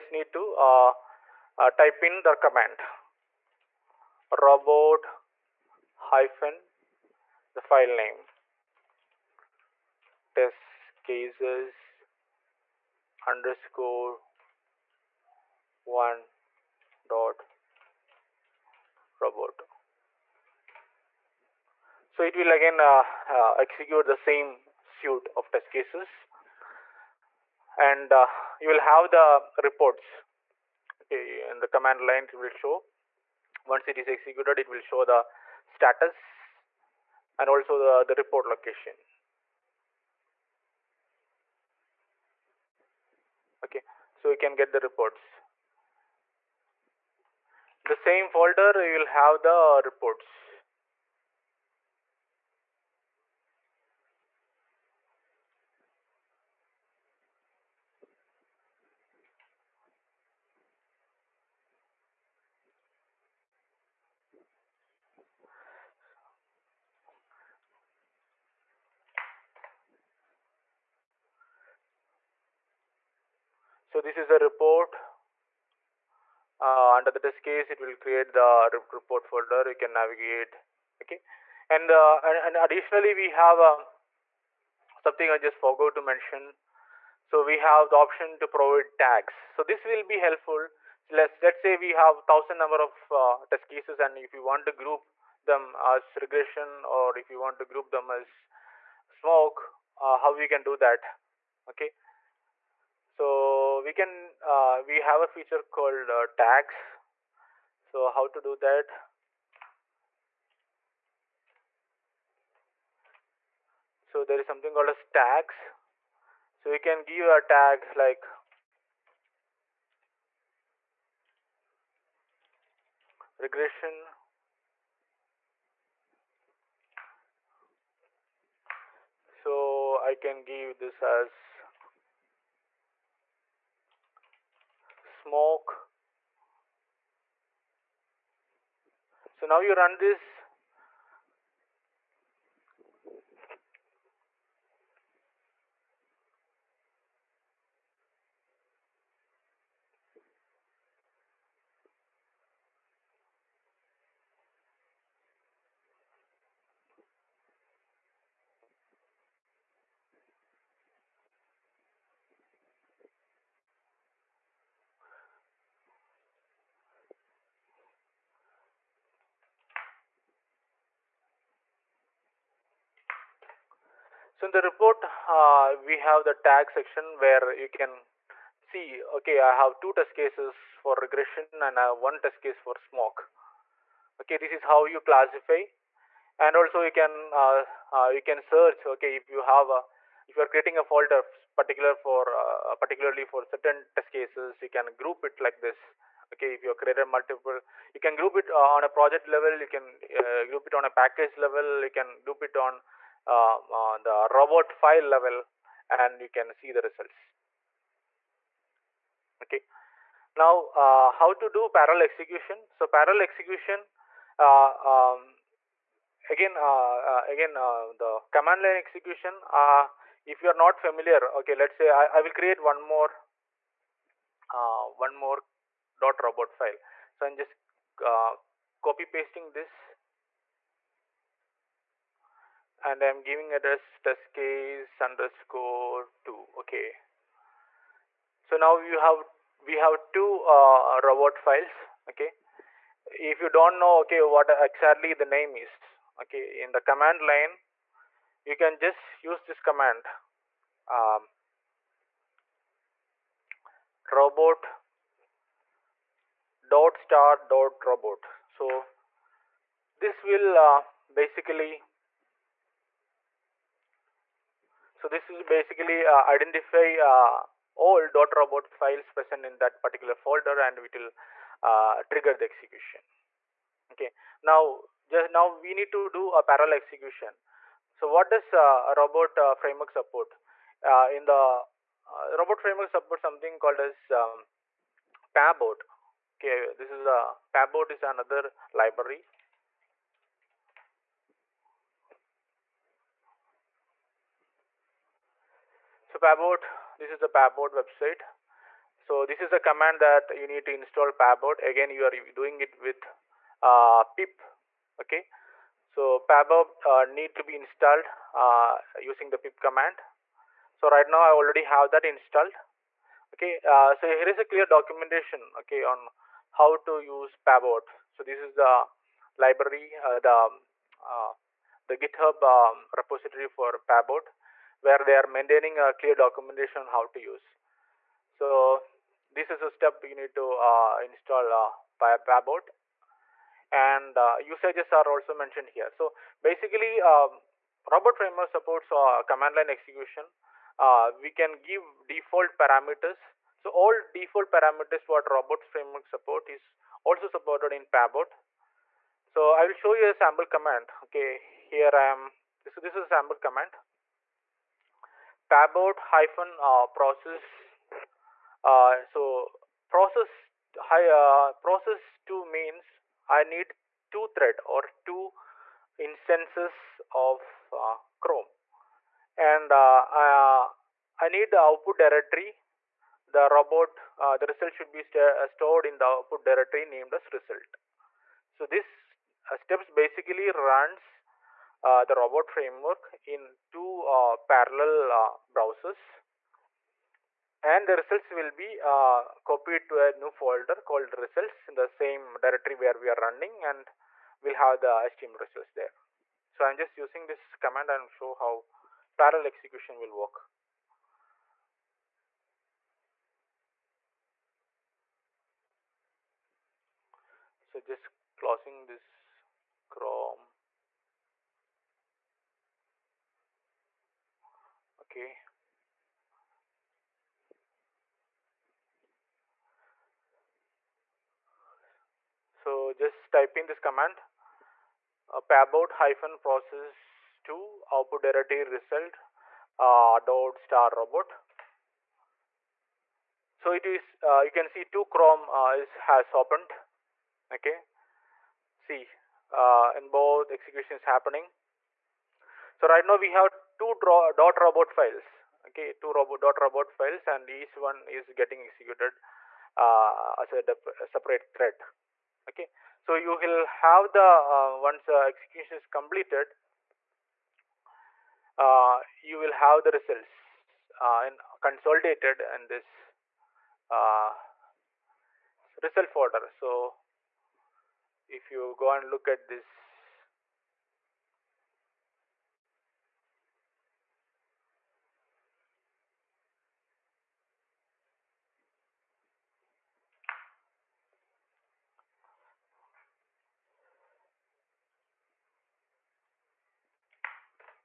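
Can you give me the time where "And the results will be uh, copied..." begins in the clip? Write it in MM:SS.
06:27.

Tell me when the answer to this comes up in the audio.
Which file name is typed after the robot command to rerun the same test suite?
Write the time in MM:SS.
00:10.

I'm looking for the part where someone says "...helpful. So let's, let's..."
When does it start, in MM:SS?
01:30.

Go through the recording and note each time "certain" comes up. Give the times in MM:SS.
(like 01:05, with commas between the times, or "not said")
03:13.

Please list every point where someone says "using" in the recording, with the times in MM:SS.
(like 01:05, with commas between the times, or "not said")
05:08, 06:36.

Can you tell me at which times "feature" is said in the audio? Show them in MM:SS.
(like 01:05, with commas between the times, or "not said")
01:45.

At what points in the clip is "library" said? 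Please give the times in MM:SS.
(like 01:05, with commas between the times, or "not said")
04:48, 05:19.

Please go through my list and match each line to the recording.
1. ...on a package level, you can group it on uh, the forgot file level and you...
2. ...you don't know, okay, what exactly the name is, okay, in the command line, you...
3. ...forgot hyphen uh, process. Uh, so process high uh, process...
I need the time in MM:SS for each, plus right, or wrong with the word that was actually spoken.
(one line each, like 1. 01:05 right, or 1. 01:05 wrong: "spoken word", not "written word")
1. 03:20 wrong: "robot", not "forgot"
2. 04:03 right
3. 05:55 wrong: "pabot", not "forgot".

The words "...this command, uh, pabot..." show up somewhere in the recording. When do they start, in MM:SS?
07:03.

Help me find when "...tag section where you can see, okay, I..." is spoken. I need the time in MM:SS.
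02:56.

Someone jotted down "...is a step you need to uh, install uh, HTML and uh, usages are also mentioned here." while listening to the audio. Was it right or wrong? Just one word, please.
wrong.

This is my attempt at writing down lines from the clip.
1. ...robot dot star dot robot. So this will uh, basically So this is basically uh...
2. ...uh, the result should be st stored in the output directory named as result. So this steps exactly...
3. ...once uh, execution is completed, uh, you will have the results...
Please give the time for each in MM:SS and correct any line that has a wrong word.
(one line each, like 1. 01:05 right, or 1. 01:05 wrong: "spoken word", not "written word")
1. 04:14 right
2. 06:14 wrong: "basically", not "exactly"
3. 07:34 right.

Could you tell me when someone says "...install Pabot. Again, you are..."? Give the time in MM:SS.
05:00.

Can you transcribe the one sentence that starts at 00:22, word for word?
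So it will again uh, uh, execute the same suite of test cases.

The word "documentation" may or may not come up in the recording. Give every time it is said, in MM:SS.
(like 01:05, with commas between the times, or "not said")
05:14, 05:26.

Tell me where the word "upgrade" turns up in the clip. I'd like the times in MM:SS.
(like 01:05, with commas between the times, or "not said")
not said.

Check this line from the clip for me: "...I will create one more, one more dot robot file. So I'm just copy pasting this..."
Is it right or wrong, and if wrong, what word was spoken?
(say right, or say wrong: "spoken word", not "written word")
right.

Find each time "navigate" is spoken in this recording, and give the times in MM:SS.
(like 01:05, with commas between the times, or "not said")
01:19.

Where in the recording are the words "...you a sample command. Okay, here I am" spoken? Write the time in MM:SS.
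05:49.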